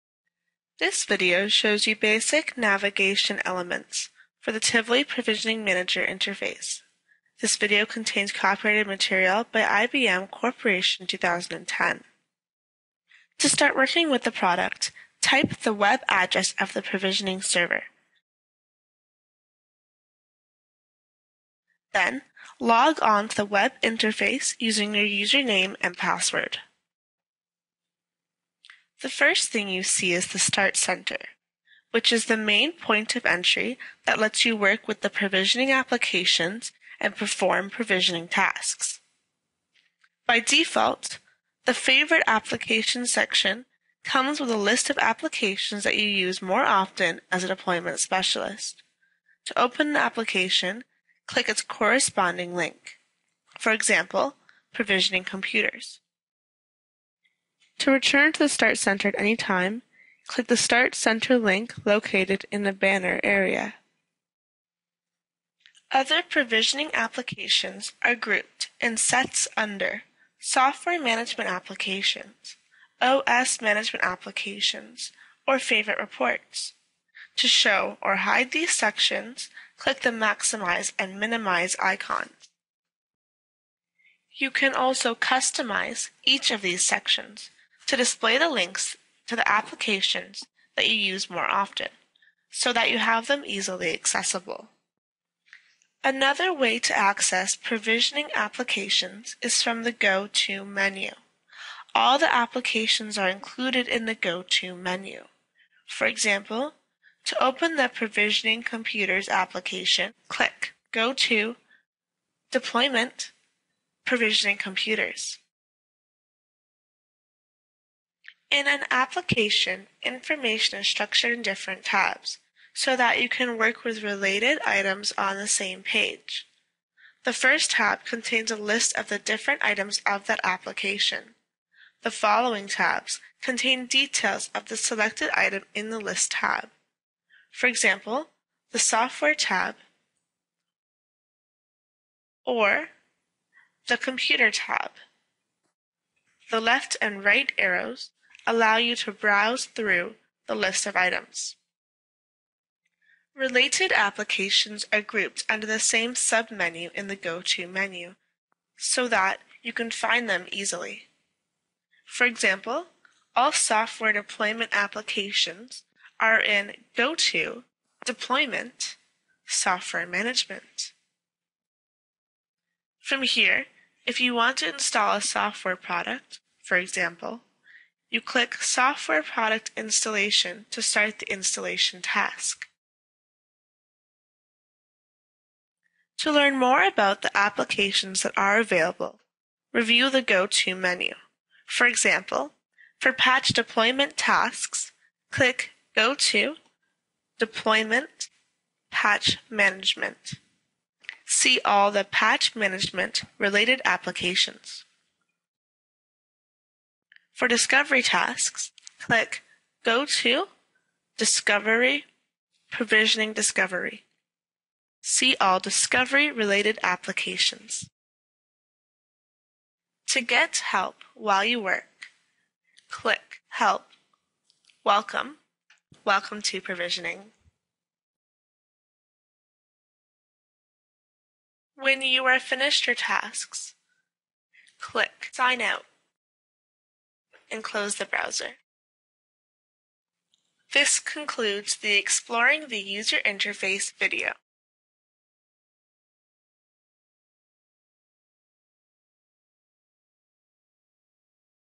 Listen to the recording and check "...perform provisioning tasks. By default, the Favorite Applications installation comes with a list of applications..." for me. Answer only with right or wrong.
wrong.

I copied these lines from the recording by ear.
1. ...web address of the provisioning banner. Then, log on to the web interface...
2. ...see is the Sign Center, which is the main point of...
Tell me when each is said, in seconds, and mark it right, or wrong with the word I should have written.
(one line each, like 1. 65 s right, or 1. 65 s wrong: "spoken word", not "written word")
1. 15 s wrong: "server", not "banner"
2. 29 s wrong: "Start", not "Sign".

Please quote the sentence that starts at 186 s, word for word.
To learn more about the applications that are available, review the Go To menu.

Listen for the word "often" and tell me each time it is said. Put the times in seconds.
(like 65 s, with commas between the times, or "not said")
46 s, 91 s.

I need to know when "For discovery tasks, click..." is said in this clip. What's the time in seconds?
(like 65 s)
207 s.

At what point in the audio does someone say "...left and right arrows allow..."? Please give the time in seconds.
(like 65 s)
146 s.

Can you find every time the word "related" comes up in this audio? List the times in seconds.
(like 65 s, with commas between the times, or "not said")
124 s, 153 s, 203 s, 216 s.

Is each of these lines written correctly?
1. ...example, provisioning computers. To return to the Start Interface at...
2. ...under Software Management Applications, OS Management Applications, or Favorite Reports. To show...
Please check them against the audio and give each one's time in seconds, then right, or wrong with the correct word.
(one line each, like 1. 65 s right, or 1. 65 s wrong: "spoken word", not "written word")
1. 53 s wrong: "Center", not "Interface"
2. 69 s right.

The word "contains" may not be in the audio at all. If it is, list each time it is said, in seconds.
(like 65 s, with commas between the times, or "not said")
7 s, 128 s, 133 s.